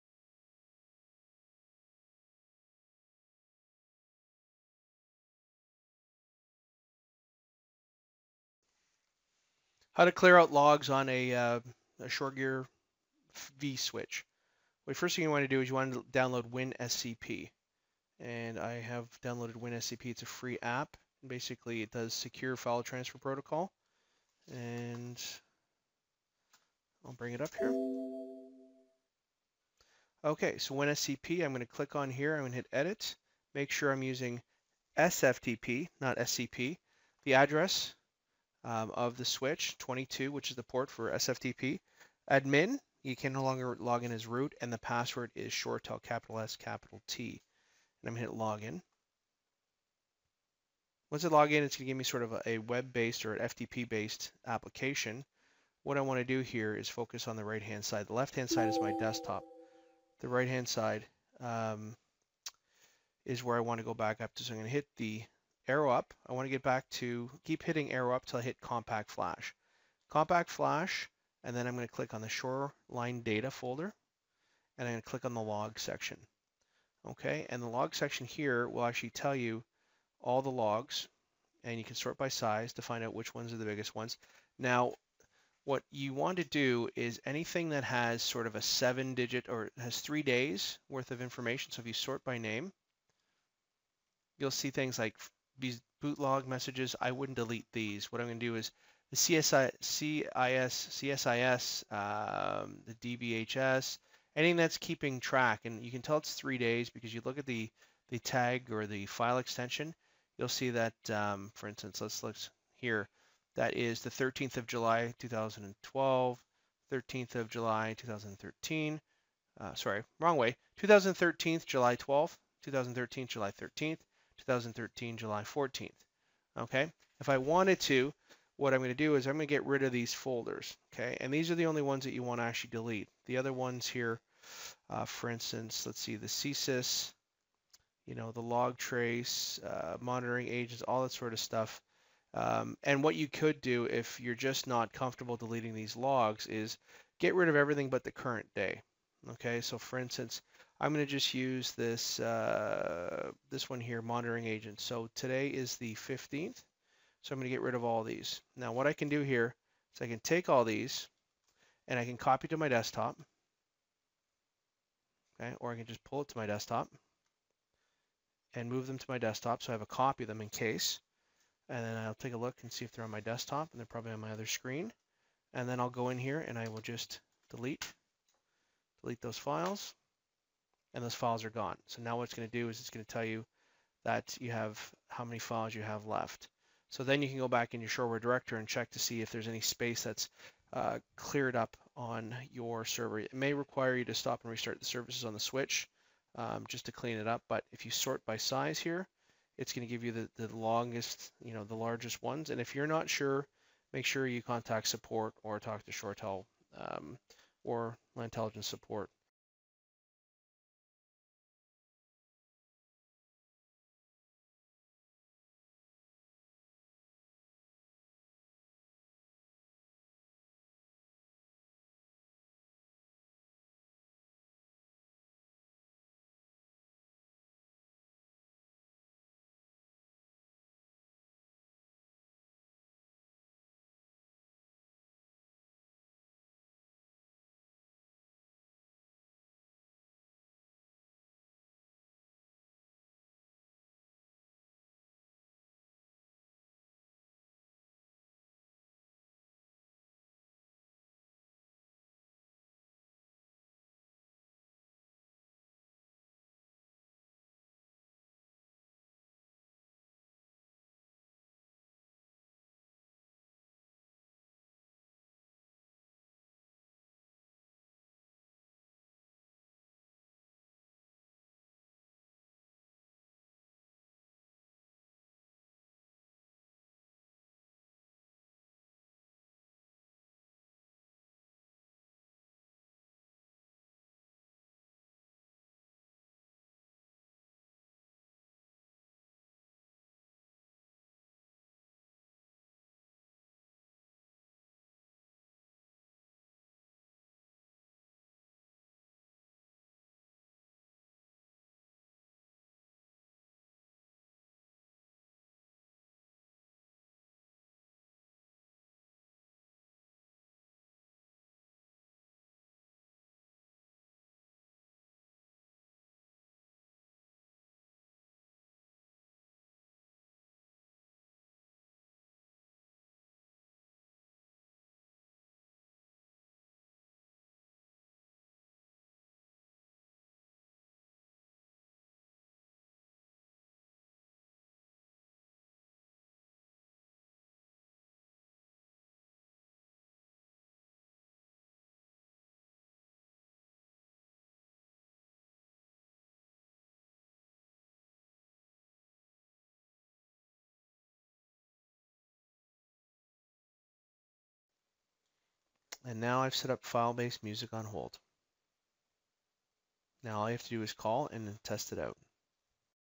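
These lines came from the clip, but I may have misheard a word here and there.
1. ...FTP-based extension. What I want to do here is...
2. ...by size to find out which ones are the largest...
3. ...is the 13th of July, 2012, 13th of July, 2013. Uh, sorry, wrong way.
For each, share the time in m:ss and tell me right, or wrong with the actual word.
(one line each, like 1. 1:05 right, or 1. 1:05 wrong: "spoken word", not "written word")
1. 0:53 wrong: "application", not "extension"
2. 1:22 wrong: "biggest", not "largest"
3. 1:53 right.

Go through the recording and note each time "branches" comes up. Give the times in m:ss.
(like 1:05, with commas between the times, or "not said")
not said.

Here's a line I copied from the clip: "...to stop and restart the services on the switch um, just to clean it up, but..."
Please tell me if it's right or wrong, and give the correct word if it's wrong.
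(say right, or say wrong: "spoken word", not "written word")
right.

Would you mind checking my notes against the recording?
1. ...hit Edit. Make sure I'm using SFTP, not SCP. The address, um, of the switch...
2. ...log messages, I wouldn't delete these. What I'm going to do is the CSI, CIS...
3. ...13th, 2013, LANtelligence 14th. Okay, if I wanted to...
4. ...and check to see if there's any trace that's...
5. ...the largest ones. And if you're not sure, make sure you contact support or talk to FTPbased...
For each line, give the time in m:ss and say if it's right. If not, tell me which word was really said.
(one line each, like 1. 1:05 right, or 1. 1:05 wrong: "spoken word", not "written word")
1. 0:32 right
2. 1:36 right
3. 2:03 wrong: "July", not "LANtelligence"
4. 3:08 wrong: "space", not "trace"
5. 3:21 wrong: "ShoreTel", not "FTPbased".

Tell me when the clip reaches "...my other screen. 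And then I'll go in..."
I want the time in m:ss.
2:54.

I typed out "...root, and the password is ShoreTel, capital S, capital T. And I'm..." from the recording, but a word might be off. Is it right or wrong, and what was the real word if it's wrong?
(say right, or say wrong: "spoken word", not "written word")
right.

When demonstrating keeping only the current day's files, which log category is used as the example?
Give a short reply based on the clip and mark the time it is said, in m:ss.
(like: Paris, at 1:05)
monitoring agent, at 2:34.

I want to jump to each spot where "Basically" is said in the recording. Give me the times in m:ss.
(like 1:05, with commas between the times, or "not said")
0:21.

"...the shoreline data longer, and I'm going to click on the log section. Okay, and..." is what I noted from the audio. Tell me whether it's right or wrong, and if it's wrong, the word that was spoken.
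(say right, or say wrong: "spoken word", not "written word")
wrong: "folder", not "longer".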